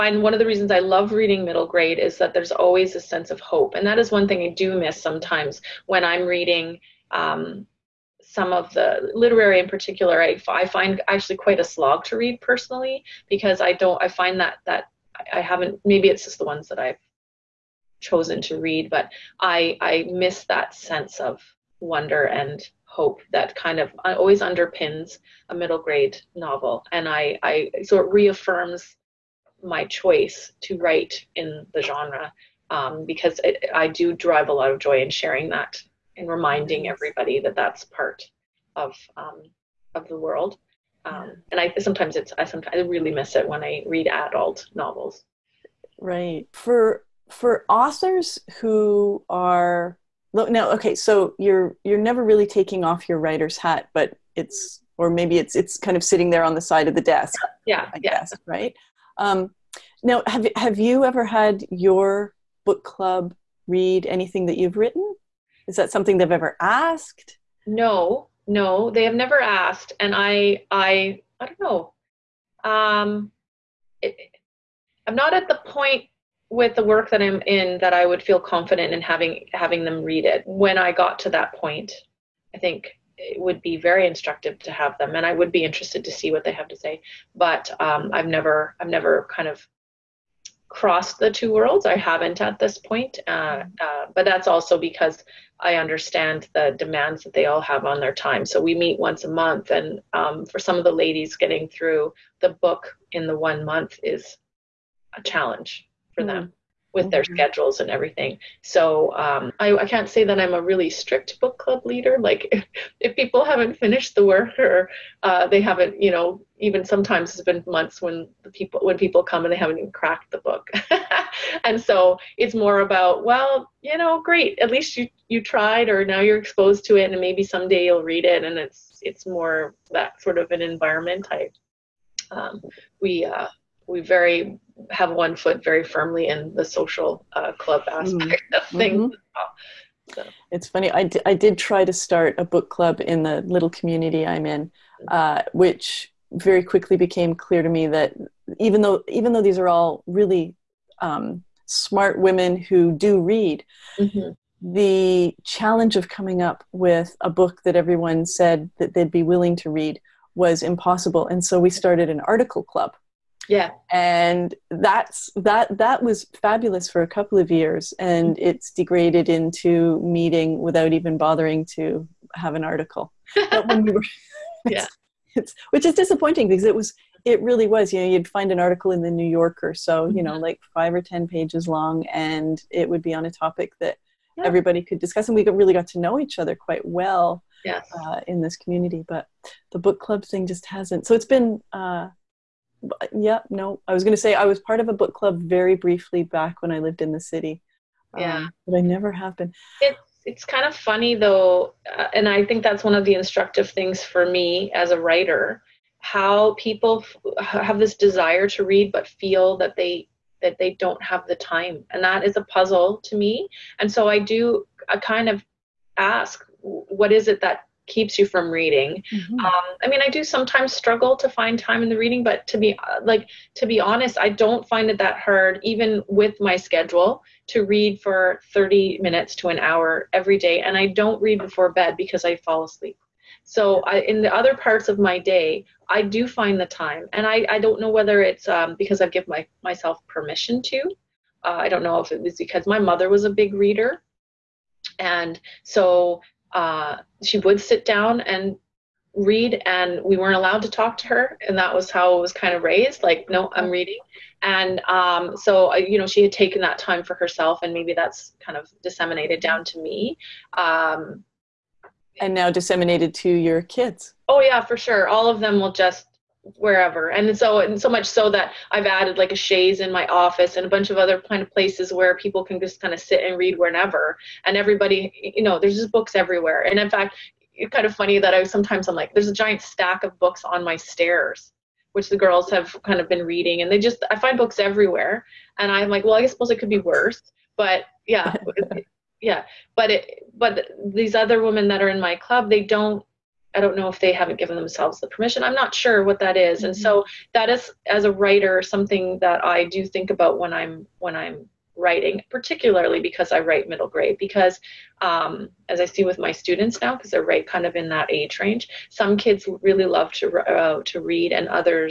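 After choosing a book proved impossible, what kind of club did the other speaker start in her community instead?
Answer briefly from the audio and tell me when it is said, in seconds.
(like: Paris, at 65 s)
article club, at 162 s.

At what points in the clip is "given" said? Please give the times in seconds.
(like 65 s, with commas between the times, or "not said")
239 s, 294 s.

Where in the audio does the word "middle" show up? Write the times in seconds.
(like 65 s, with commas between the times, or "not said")
1 s, 25 s, 303 s.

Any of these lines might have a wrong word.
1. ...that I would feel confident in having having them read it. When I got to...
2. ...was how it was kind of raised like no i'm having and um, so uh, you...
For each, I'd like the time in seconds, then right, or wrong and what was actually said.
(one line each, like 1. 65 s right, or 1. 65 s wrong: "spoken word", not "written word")
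1. 77 s right
2. 251 s wrong: "reading", not "having".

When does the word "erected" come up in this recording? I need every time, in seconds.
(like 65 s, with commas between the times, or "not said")
not said.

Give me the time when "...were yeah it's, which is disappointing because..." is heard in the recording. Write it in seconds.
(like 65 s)
173 s.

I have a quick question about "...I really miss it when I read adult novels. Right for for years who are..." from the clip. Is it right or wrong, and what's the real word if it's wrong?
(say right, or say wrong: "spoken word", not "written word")
wrong: "authors", not "years".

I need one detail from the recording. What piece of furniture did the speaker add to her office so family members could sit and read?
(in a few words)
a chaise.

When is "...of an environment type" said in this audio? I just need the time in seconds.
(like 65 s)
130 s.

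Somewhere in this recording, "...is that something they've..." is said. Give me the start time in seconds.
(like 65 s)
65 s.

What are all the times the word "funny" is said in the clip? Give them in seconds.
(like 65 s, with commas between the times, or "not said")
140 s, 200 s, 277 s.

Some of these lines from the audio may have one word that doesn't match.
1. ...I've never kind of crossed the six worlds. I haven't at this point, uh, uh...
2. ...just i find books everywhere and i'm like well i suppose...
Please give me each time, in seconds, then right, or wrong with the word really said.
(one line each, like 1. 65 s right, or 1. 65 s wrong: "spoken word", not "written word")
1. 88 s wrong: "two", not "six"
2. 283 s right.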